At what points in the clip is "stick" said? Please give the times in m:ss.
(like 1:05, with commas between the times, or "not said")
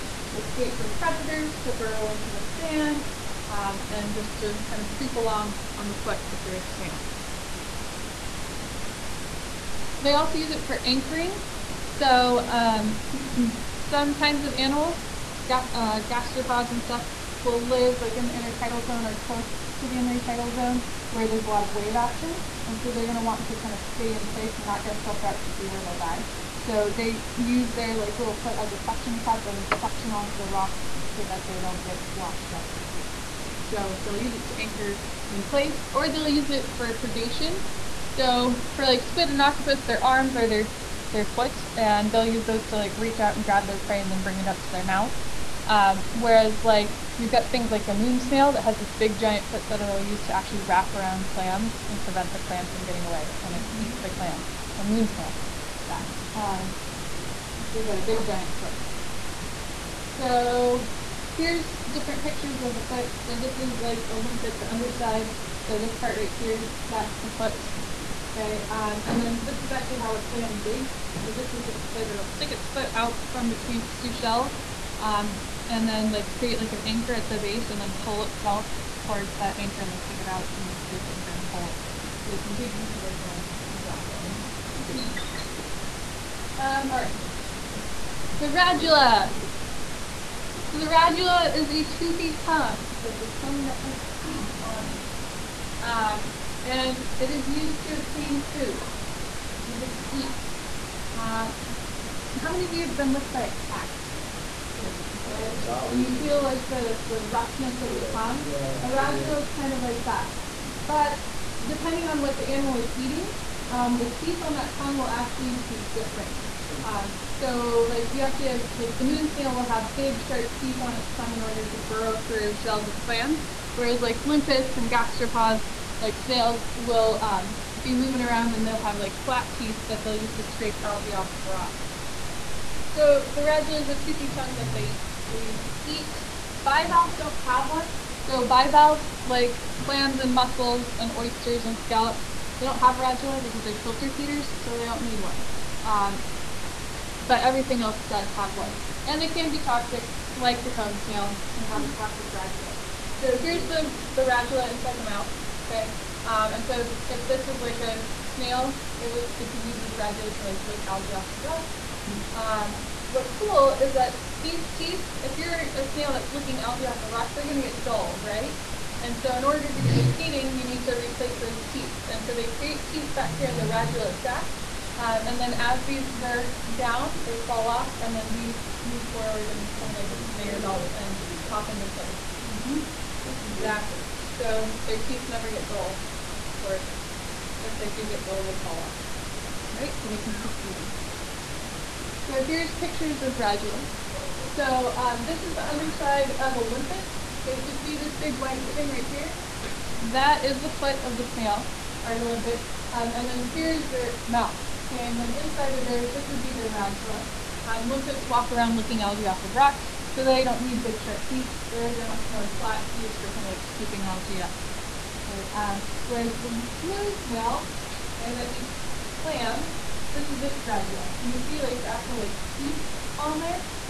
1:12, 1:19.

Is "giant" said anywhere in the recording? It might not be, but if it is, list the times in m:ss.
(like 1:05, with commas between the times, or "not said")
0:49, 0:58.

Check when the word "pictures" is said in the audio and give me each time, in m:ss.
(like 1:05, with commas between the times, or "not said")
1:02, 3:12.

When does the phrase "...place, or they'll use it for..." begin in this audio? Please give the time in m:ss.
0:35.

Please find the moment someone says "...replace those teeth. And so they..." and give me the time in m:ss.
2:50.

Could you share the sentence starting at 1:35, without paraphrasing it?
Uh, and it is used to obtain food.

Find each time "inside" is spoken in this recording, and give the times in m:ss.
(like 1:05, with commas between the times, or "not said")
2:34, 3:25.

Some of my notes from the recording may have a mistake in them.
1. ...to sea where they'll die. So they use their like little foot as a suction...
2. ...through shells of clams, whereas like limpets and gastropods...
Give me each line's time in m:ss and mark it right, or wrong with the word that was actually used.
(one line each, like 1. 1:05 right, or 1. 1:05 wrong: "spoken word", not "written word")
1. 0:25 right
2. 2:02 right.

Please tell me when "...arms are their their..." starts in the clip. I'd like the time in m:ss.
0:40.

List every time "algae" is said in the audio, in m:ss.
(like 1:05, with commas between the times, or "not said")
2:10, 2:40, 2:46, 3:29, 3:34.